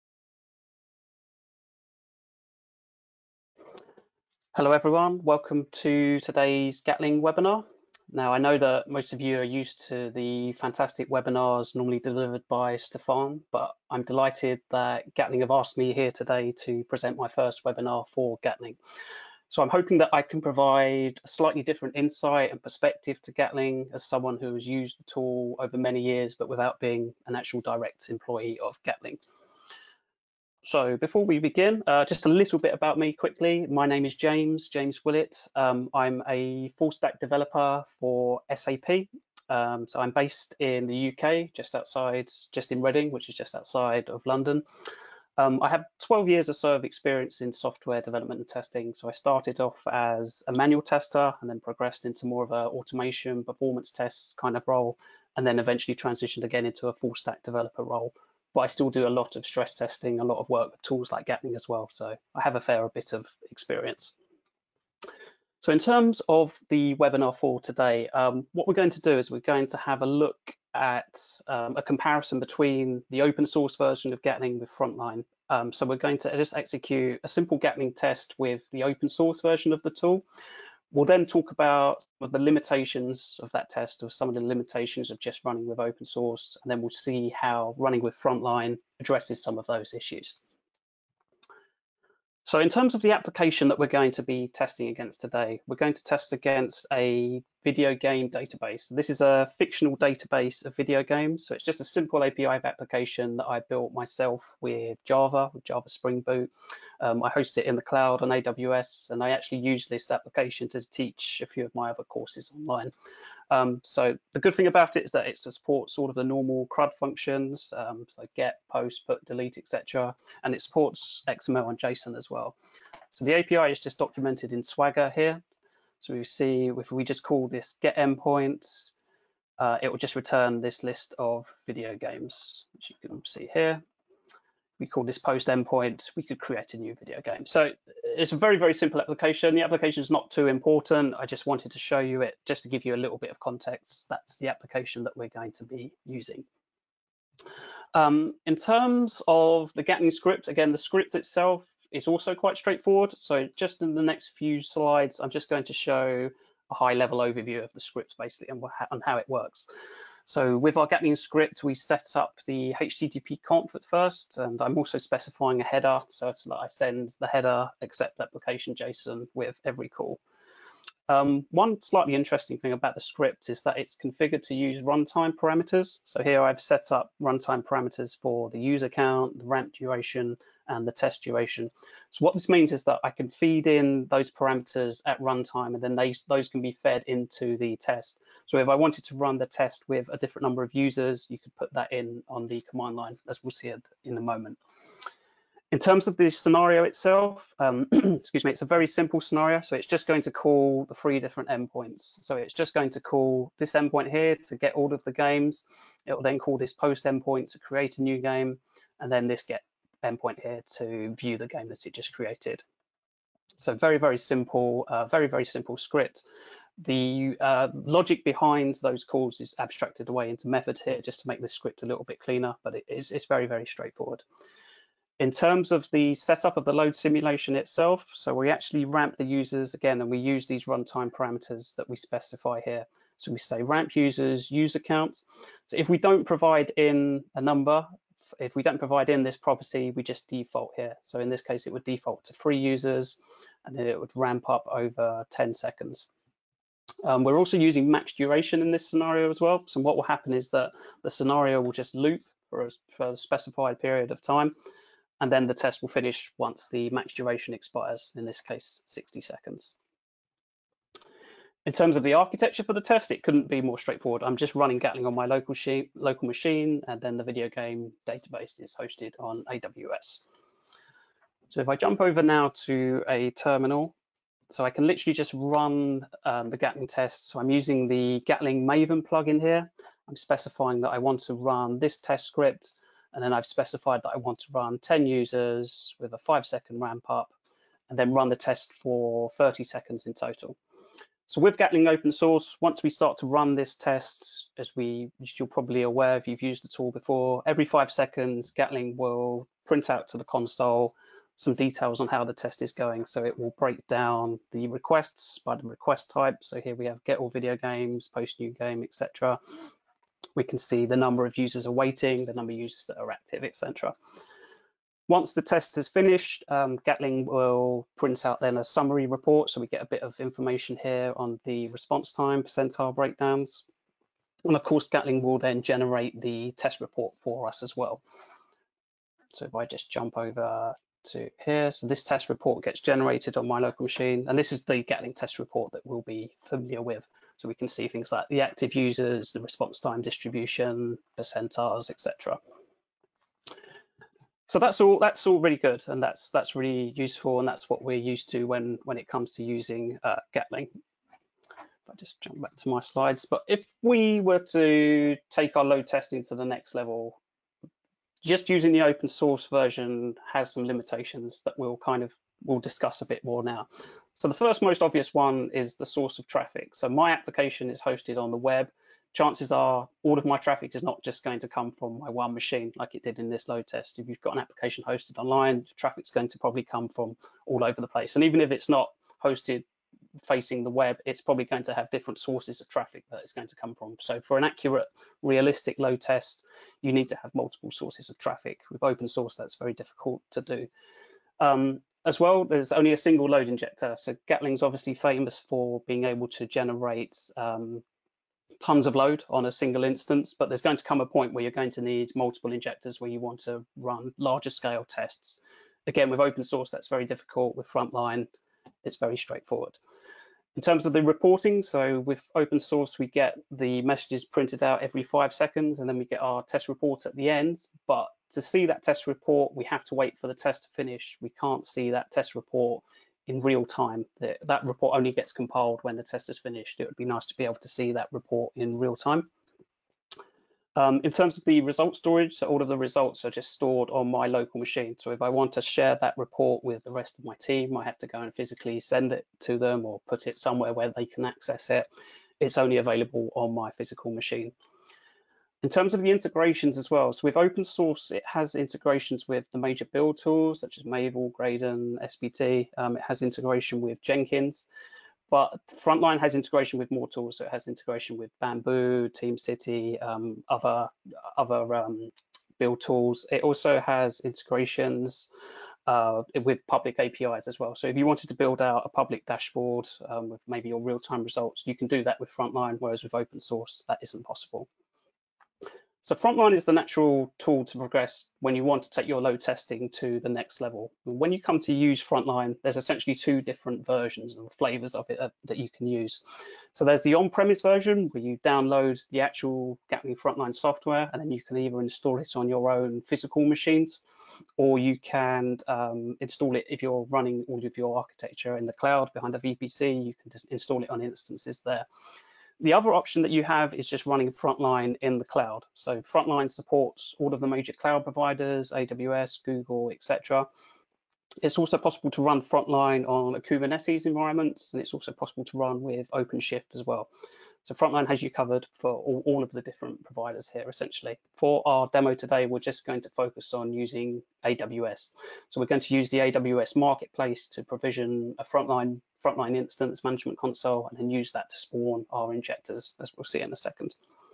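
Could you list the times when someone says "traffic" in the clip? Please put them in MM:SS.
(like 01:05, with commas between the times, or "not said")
06:06, 06:10, 06:15, 06:22, 06:28.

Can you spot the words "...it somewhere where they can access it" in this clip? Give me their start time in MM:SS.
07:20.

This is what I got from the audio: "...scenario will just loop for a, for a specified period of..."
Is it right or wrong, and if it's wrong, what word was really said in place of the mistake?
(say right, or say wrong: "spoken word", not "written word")
right.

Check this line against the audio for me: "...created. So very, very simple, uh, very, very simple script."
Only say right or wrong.
right.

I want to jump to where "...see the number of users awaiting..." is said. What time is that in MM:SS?
05:10.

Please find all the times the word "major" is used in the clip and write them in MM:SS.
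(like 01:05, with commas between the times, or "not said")
07:29, 08:27.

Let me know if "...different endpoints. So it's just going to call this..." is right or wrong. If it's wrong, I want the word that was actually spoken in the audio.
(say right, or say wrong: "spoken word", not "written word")
right.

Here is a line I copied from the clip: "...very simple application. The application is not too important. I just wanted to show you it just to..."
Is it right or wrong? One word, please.
right.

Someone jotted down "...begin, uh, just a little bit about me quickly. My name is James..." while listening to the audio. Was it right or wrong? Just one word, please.
right.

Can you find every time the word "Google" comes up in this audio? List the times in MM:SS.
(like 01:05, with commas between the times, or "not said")
08:29.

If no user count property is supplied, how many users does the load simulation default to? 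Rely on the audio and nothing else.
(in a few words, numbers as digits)
3.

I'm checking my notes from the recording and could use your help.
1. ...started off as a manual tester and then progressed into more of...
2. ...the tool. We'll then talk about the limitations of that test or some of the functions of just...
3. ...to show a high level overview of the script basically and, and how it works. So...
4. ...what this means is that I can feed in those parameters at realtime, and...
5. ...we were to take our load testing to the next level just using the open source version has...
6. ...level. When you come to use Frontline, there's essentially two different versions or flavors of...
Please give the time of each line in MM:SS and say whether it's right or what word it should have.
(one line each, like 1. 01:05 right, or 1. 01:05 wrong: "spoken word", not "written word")
1. 00:49 right
2. 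01:19 wrong: "limitations", not "functions"
3. 02:35 right
4. 03:02 wrong: "runtime", not "realtime"
5. 05:53 right
6. 08:00 right.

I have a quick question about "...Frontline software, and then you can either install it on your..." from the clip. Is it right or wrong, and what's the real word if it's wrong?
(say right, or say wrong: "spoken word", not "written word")
right.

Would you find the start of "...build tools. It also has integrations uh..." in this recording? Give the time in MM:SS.
07:42.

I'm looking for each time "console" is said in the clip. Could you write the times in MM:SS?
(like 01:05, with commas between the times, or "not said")
05:00, 08:50.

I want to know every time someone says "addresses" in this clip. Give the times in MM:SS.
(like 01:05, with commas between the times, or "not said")
01:29.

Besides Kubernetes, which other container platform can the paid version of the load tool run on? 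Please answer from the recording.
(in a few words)
OpenShift.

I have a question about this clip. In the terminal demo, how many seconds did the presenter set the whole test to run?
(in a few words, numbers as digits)
30.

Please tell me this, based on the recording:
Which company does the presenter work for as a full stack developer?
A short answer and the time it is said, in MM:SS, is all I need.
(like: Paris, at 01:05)
SAP, at 00:38.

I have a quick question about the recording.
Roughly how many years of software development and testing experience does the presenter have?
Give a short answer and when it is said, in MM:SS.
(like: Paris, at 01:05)
12, at 00:45.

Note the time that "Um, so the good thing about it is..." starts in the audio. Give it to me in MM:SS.
01:53.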